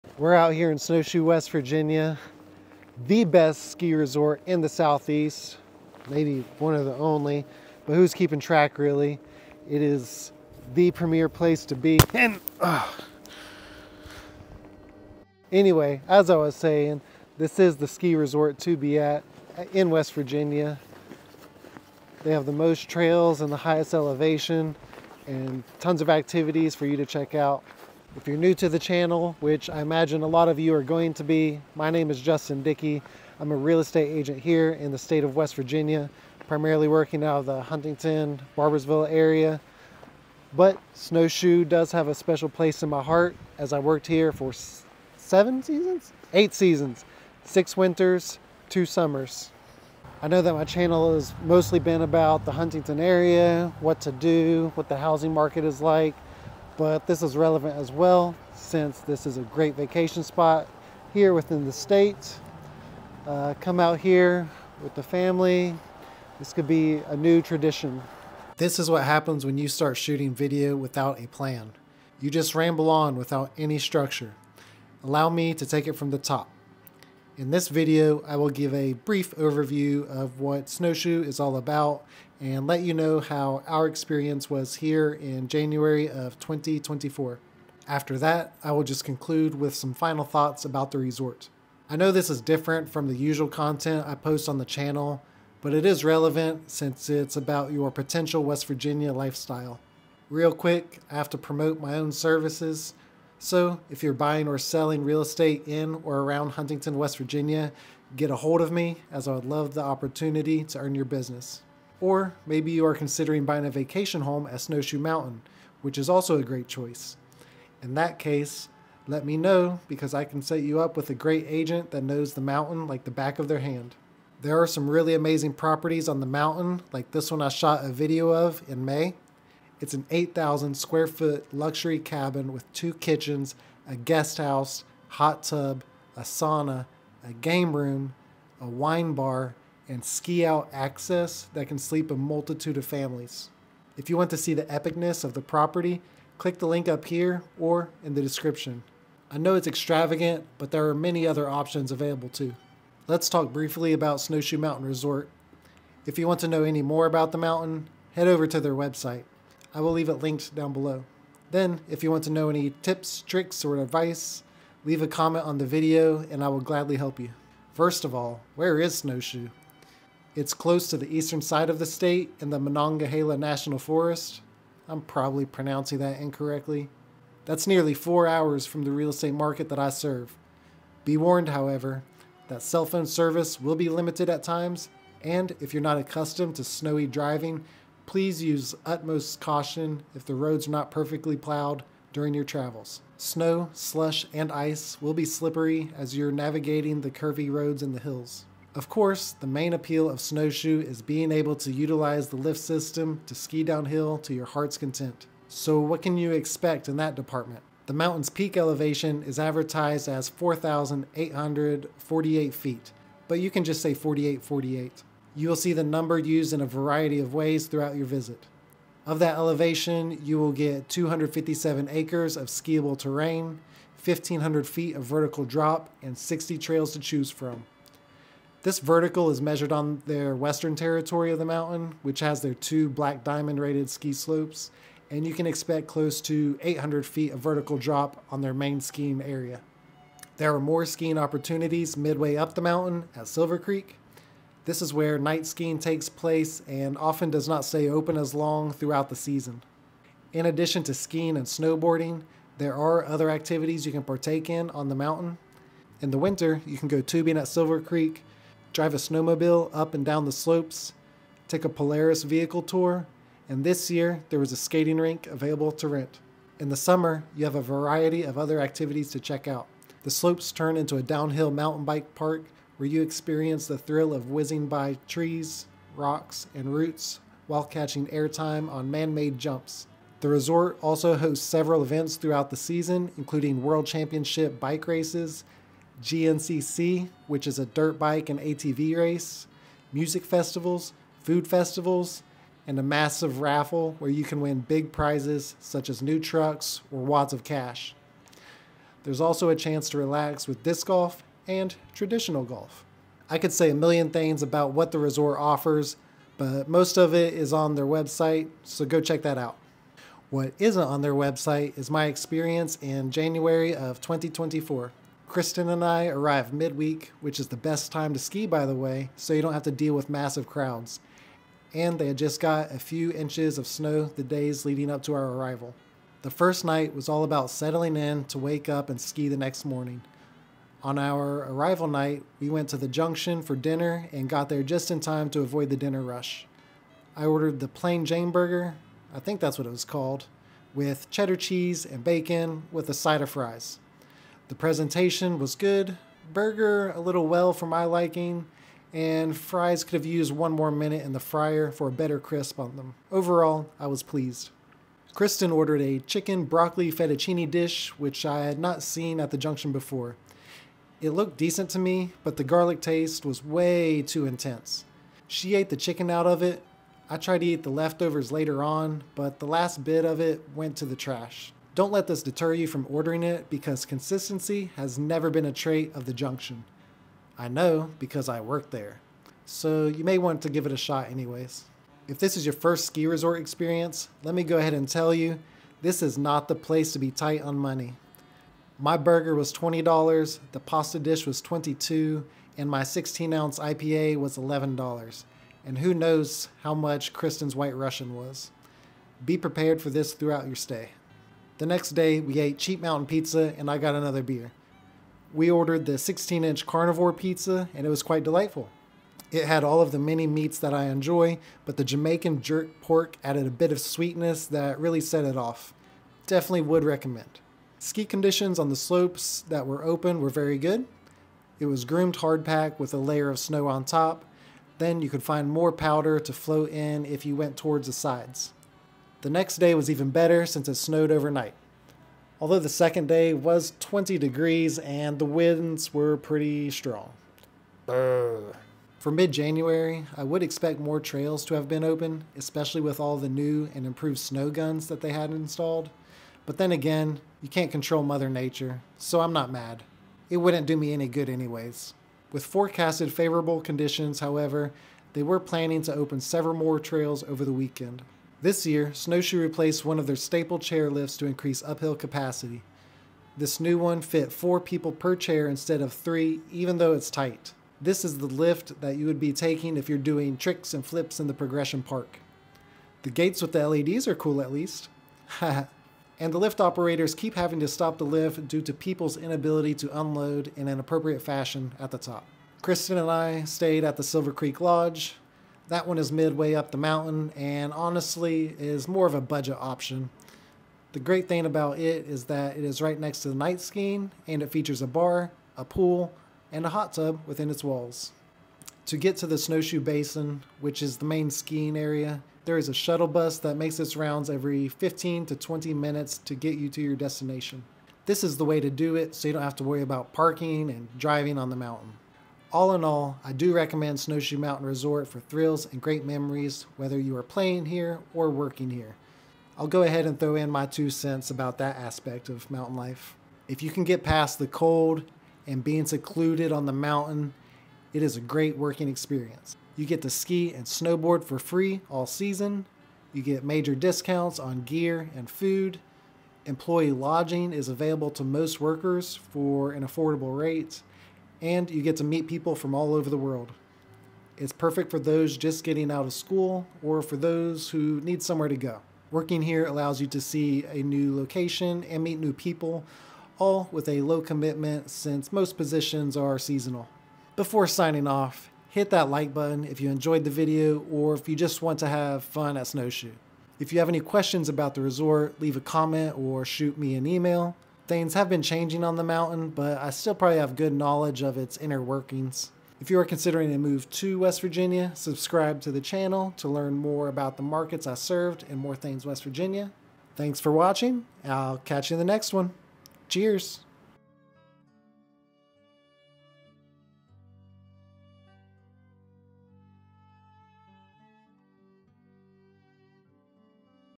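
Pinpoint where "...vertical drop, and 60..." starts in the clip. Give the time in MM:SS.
03:45.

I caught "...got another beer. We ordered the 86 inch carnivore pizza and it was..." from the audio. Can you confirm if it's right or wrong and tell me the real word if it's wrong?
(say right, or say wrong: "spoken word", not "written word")
wrong: "16", not "86".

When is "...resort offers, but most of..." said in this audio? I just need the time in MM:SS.
05:04.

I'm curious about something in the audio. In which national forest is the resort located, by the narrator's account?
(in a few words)
Monongahela National Forest.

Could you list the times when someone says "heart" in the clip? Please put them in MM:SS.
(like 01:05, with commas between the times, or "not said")
00:43, 03:24.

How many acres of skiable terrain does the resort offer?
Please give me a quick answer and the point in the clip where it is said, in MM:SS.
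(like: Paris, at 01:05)
257, at 03:40.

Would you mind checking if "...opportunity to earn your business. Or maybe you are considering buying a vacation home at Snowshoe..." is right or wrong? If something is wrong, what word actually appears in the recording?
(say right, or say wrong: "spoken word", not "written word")
right.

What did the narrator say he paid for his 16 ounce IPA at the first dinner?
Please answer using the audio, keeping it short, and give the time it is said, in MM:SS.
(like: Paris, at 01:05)
$11, at 06:34.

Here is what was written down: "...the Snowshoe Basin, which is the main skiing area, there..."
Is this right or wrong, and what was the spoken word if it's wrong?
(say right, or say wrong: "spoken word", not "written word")
right.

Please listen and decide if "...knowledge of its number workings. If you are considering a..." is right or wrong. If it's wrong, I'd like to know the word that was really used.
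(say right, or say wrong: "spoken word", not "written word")
wrong: "inner", not "number".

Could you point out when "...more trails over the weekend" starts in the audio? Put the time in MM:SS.
07:36.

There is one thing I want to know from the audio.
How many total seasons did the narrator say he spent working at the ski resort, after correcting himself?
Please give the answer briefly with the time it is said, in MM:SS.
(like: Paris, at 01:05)
8, at 00:46.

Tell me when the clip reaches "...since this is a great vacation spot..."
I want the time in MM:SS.
00:58.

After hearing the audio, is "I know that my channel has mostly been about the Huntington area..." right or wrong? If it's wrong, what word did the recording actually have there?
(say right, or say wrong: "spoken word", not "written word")
right.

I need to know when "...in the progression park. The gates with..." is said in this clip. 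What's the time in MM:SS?
07:51.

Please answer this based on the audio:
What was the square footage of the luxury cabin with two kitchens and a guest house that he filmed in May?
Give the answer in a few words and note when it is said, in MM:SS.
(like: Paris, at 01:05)
8,000, at 02:10.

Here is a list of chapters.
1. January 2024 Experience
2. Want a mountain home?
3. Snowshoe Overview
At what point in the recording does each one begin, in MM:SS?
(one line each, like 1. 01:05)
1. 05:10
2. 01:39
3. 02:32.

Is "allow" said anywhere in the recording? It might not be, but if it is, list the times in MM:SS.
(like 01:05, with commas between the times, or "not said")
01:15, 09:09.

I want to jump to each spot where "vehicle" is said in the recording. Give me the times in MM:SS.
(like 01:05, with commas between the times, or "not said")
04:22.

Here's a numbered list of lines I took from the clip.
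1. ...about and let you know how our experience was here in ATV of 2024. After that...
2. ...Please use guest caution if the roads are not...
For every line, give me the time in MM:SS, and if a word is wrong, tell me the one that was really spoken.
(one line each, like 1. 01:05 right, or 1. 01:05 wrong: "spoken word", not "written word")
1. 01:21 wrong: "January", not "ATV"
2. 03:08 wrong: "utmost", not "guest".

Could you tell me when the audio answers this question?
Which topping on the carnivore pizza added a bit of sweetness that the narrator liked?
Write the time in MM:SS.
06:51.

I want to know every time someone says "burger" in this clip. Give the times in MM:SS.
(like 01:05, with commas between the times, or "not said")
05:38, 05:46, 06:28.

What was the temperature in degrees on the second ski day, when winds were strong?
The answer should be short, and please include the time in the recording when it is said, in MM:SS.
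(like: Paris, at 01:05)
20, at 07:13.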